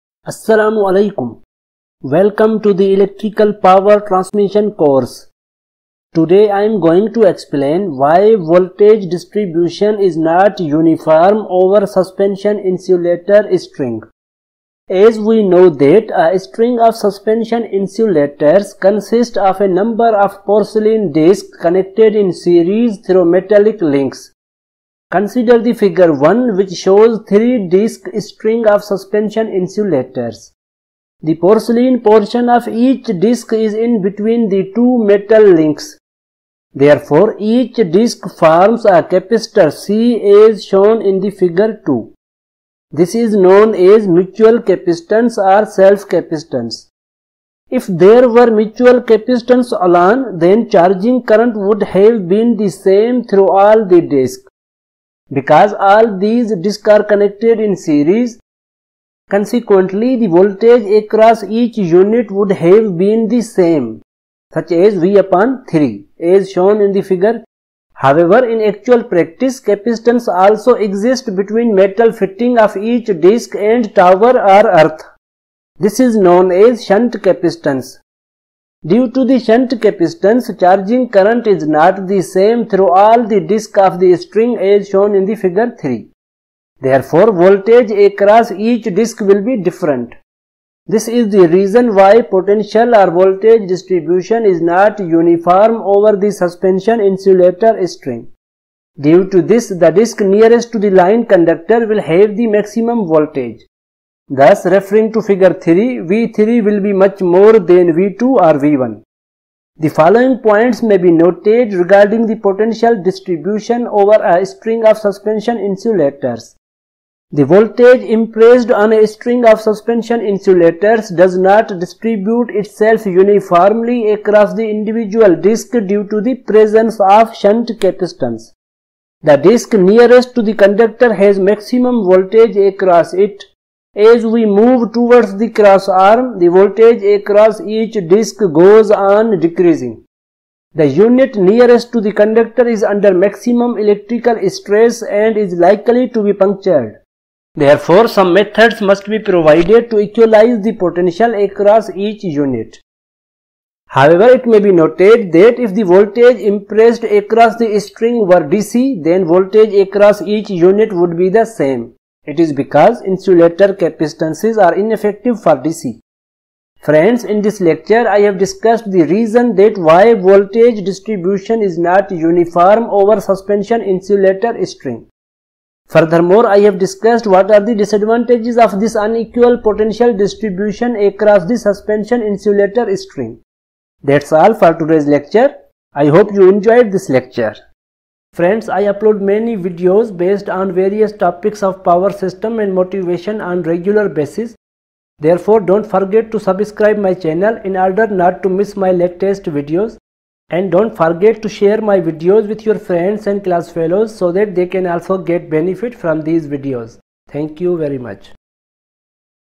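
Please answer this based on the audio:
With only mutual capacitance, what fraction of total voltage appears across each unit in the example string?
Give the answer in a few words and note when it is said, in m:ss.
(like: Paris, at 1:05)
V/3, at 1:04.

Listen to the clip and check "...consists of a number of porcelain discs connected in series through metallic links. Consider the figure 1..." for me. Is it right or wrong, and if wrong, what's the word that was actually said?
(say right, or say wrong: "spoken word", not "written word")
right.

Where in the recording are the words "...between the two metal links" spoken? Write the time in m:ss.
0:34.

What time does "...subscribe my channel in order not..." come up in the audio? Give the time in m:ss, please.
3:16.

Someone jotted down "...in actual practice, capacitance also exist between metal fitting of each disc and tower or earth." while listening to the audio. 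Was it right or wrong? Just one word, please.
right.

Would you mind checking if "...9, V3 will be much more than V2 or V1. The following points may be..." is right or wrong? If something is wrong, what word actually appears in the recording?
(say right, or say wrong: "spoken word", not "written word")
wrong: "3", not "9".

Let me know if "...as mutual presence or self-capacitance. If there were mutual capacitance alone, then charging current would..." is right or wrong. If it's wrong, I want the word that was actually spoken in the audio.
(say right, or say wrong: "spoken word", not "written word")
wrong: "capacitance", not "presence".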